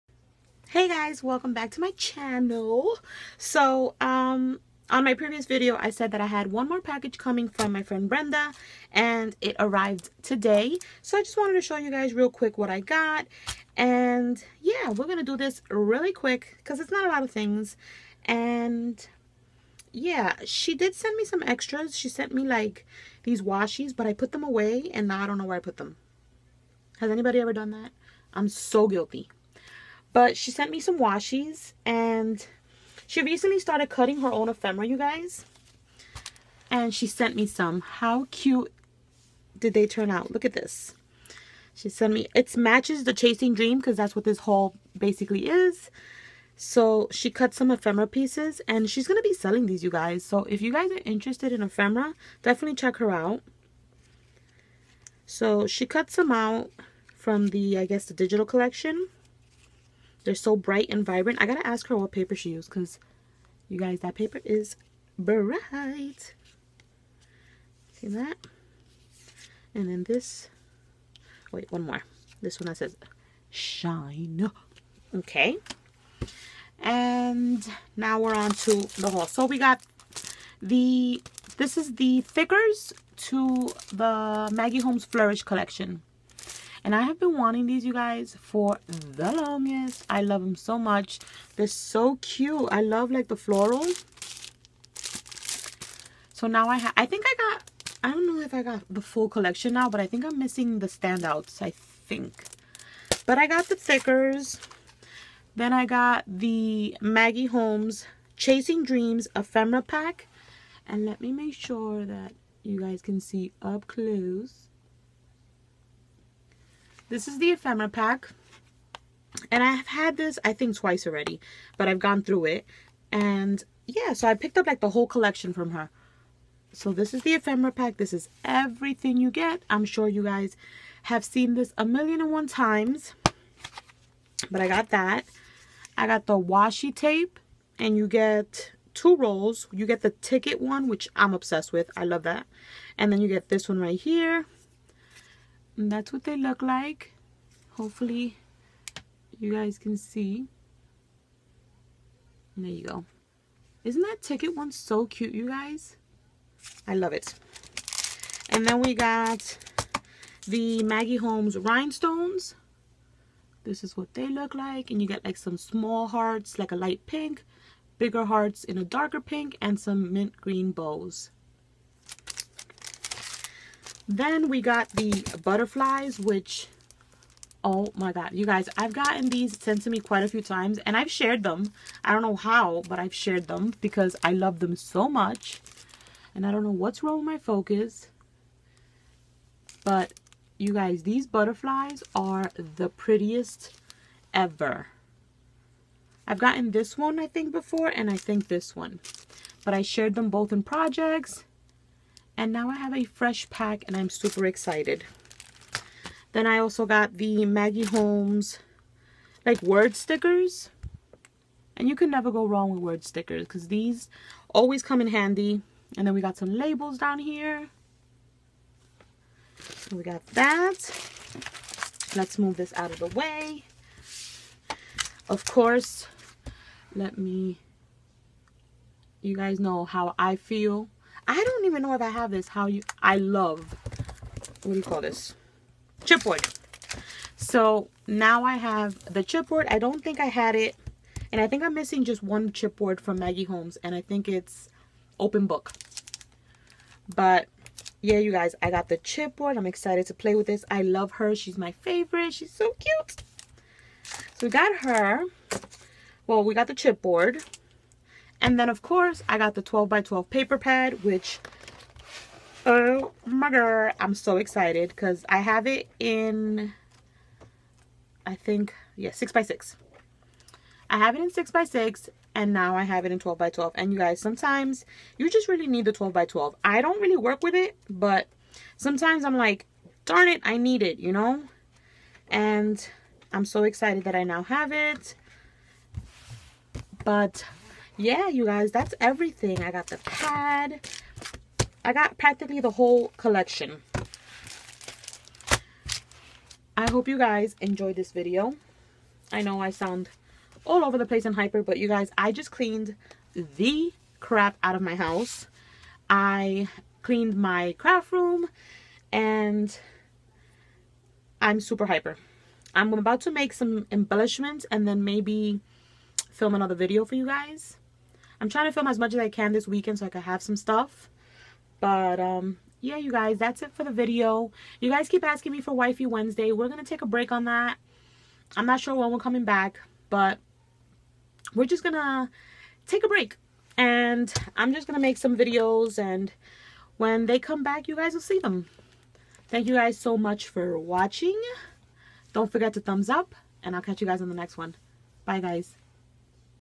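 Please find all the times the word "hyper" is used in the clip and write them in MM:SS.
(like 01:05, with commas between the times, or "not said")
05:01, 05:11.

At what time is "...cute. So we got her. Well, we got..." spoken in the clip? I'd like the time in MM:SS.
04:12.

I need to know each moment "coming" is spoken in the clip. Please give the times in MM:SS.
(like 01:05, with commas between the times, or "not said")
00:07, 05:29.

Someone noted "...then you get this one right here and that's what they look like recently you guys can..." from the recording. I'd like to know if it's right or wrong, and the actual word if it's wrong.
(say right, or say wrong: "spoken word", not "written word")
wrong: "hopefully", not "recently".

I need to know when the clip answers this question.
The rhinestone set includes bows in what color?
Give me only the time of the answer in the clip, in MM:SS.
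02:50.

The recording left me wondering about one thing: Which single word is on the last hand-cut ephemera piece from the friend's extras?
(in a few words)
shine.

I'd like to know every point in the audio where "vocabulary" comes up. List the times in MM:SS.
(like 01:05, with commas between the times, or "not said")
not said.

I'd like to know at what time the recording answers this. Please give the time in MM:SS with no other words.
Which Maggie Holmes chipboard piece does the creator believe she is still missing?
04:05.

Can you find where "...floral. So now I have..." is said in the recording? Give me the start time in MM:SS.
01:33.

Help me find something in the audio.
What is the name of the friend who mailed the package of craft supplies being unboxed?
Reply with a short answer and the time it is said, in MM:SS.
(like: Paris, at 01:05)
Brenda, at 00:08.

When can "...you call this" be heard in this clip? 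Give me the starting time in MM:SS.
03:54.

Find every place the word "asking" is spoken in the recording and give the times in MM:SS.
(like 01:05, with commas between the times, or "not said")
05:25.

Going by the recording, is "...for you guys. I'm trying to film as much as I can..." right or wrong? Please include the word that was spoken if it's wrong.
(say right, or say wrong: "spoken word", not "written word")
right.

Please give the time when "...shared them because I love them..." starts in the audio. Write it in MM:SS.
03:03.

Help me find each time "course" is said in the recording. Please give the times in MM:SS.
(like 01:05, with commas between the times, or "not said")
03:45, 04:18.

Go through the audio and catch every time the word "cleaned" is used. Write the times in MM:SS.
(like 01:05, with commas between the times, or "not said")
05:02, 05:07.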